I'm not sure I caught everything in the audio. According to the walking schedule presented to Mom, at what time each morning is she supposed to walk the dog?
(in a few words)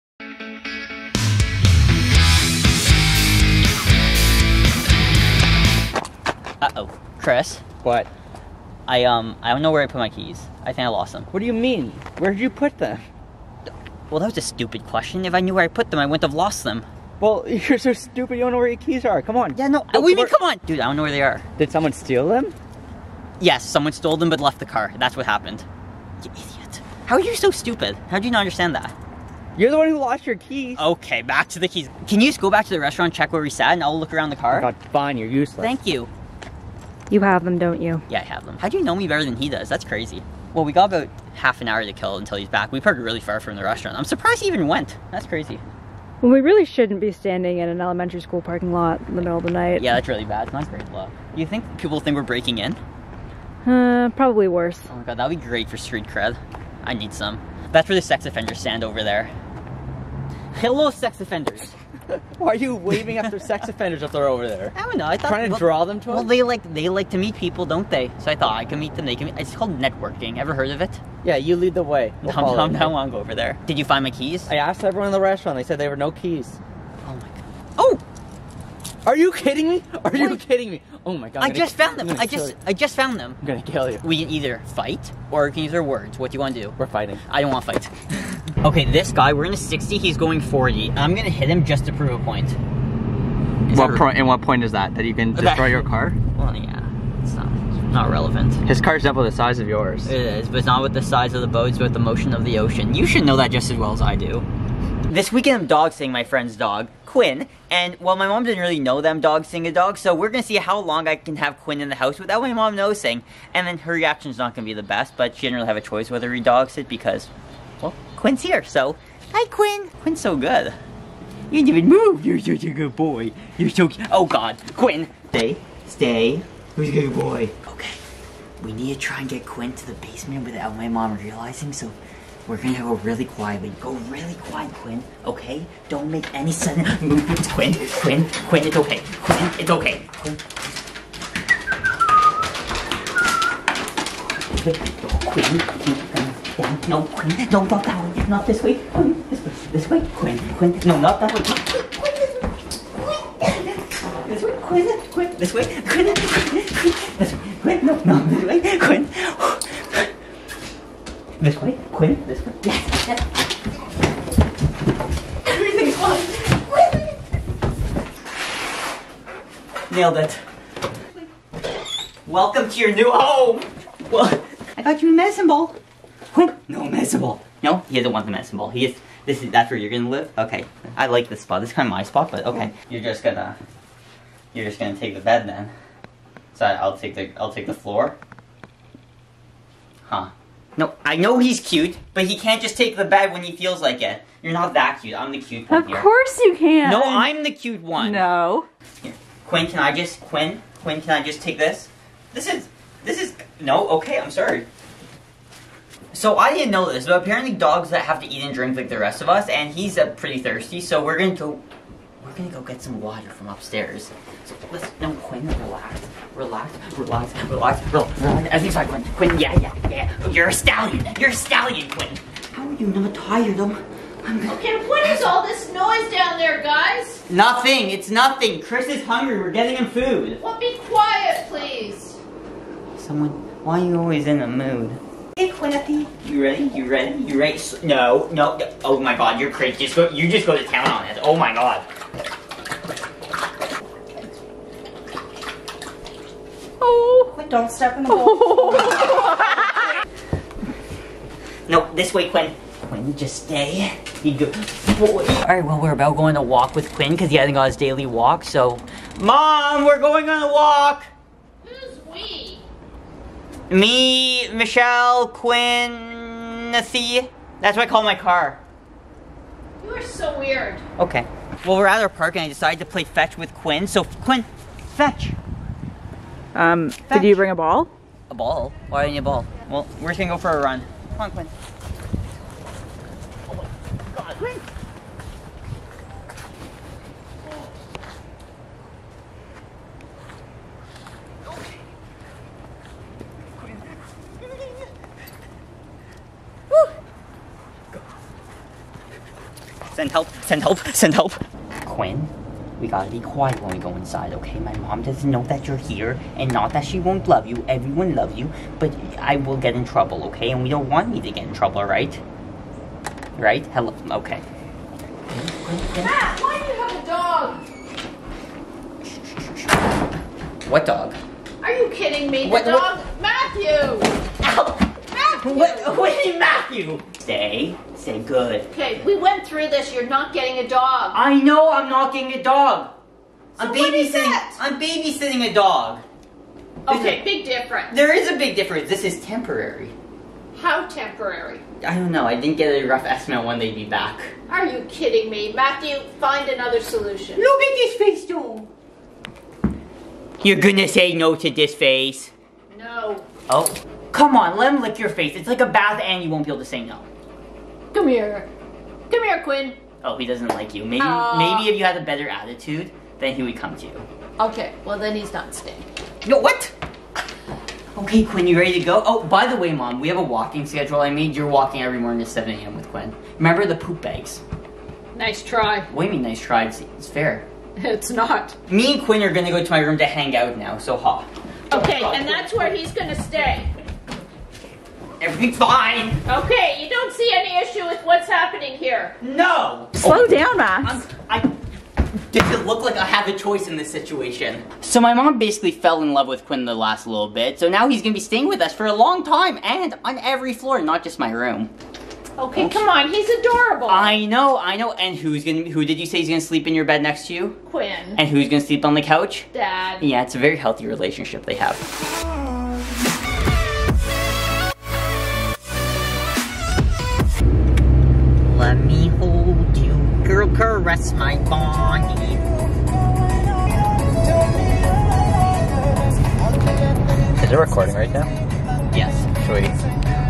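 7 a.m.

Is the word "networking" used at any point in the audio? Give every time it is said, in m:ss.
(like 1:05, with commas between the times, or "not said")
1:09.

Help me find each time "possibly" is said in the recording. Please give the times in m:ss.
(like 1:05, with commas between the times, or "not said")
not said.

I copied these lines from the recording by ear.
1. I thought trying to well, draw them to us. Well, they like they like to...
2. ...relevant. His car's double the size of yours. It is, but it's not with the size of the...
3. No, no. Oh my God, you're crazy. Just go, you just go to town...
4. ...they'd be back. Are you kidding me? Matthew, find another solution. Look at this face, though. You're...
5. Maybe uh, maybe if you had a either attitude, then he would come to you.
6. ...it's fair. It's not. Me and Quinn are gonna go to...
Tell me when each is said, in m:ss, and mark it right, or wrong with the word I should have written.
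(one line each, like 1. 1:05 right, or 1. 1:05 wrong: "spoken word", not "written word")
1. 1:05 right
2. 1:38 right
3. 3:57 right
4. 5:43 right
5. 6:00 wrong: "better", not "either"
6. 6:16 right.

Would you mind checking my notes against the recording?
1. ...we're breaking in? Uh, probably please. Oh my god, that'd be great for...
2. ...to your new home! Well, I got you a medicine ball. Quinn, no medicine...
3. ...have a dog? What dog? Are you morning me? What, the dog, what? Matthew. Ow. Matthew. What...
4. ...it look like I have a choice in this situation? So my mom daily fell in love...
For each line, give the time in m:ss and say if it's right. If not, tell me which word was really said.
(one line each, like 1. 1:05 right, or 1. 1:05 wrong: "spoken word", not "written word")
1. 0:52 wrong: "worse", not "please"
2. 2:52 right
3. 5:17 wrong: "kidding", not "morning"
4. 6:32 wrong: "basically", not "daily".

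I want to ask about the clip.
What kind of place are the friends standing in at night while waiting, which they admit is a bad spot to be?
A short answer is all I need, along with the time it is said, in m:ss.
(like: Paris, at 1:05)
elementary school parking lot, at 0:47.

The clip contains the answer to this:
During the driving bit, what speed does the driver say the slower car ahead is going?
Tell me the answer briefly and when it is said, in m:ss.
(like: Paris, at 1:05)
40, at 1:30.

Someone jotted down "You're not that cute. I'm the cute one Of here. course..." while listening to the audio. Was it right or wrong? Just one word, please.
right.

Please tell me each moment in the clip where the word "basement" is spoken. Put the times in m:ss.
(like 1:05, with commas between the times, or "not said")
2:09.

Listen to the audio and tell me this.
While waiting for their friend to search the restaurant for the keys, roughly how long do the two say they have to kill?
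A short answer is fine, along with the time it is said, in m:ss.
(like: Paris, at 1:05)
half an hour, at 0:41.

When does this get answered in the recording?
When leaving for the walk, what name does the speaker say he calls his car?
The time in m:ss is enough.
4:26.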